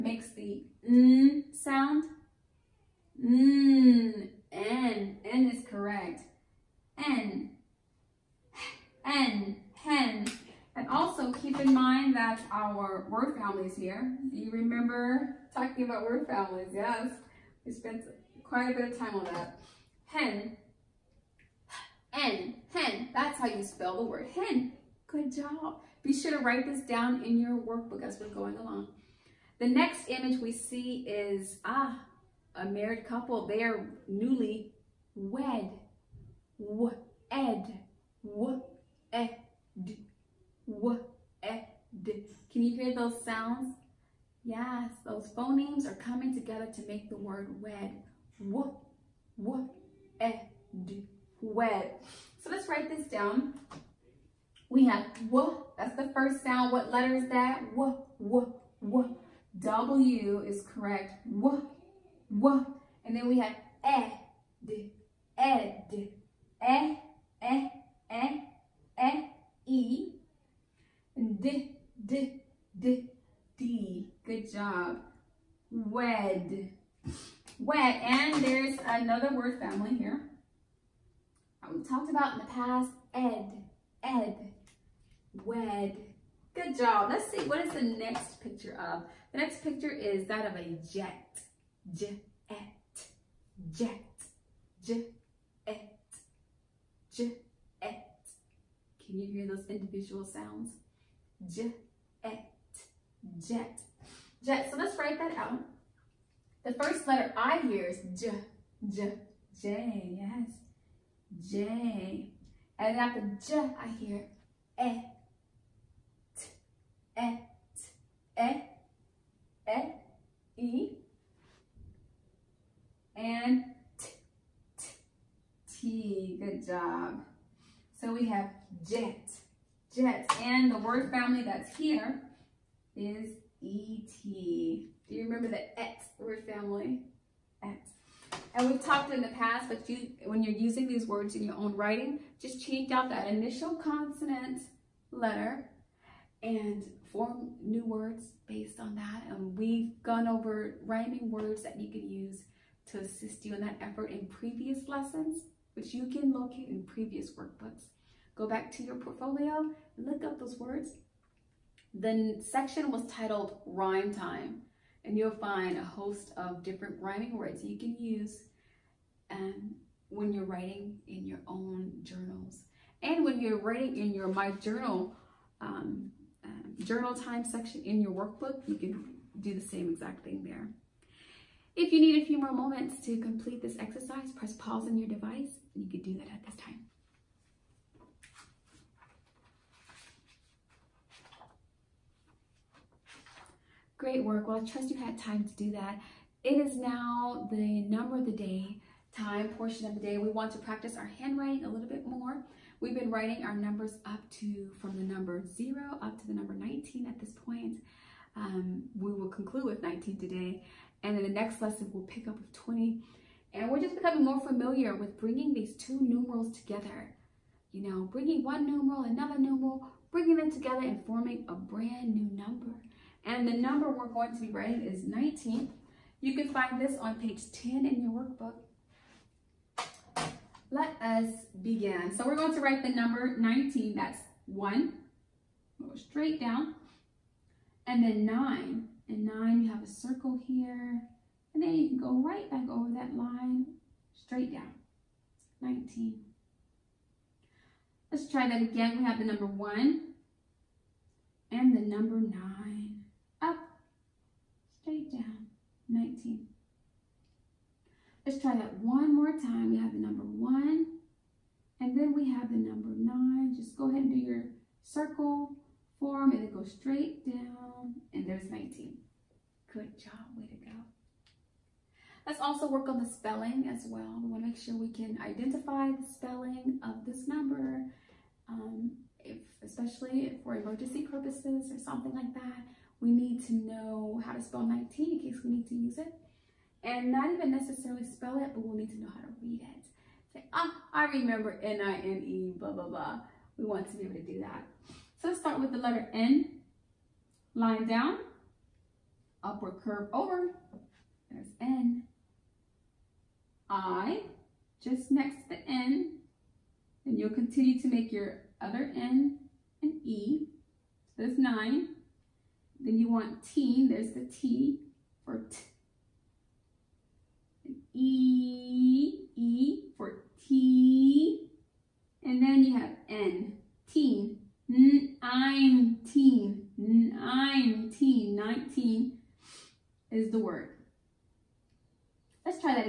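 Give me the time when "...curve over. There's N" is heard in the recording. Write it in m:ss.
4:59.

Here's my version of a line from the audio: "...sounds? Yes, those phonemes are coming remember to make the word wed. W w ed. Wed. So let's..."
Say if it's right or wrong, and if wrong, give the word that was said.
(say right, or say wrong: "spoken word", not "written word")
wrong: "together", not "remember".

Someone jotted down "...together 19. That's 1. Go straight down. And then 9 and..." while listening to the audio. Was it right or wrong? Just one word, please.
wrong.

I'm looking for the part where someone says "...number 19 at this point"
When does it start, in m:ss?
3:26.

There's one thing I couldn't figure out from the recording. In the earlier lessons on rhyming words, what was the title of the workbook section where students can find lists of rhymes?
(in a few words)
Rhyme Time.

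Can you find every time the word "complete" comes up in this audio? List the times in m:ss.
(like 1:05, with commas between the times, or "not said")
3:03.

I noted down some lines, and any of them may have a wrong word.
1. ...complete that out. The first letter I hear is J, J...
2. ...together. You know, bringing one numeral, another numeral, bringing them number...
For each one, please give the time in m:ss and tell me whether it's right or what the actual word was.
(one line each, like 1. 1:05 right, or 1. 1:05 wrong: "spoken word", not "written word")
1. 1:44 wrong: "write", not "complete"
2. 3:36 wrong: "together", not "number".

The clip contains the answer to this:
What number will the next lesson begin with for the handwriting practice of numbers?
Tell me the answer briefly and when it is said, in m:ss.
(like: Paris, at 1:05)
20, at 3:32.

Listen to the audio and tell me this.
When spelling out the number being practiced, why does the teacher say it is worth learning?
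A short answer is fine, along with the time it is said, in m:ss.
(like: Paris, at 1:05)
emergency purposes, at 4:40.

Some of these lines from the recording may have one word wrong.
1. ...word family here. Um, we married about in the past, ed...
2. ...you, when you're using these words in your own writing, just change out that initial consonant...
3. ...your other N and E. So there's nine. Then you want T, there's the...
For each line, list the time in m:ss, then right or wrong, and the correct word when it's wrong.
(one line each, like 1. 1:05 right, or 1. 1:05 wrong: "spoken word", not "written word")
1. 1:19 wrong: "talked", not "married"
2. 2:19 right
3. 5:08 right.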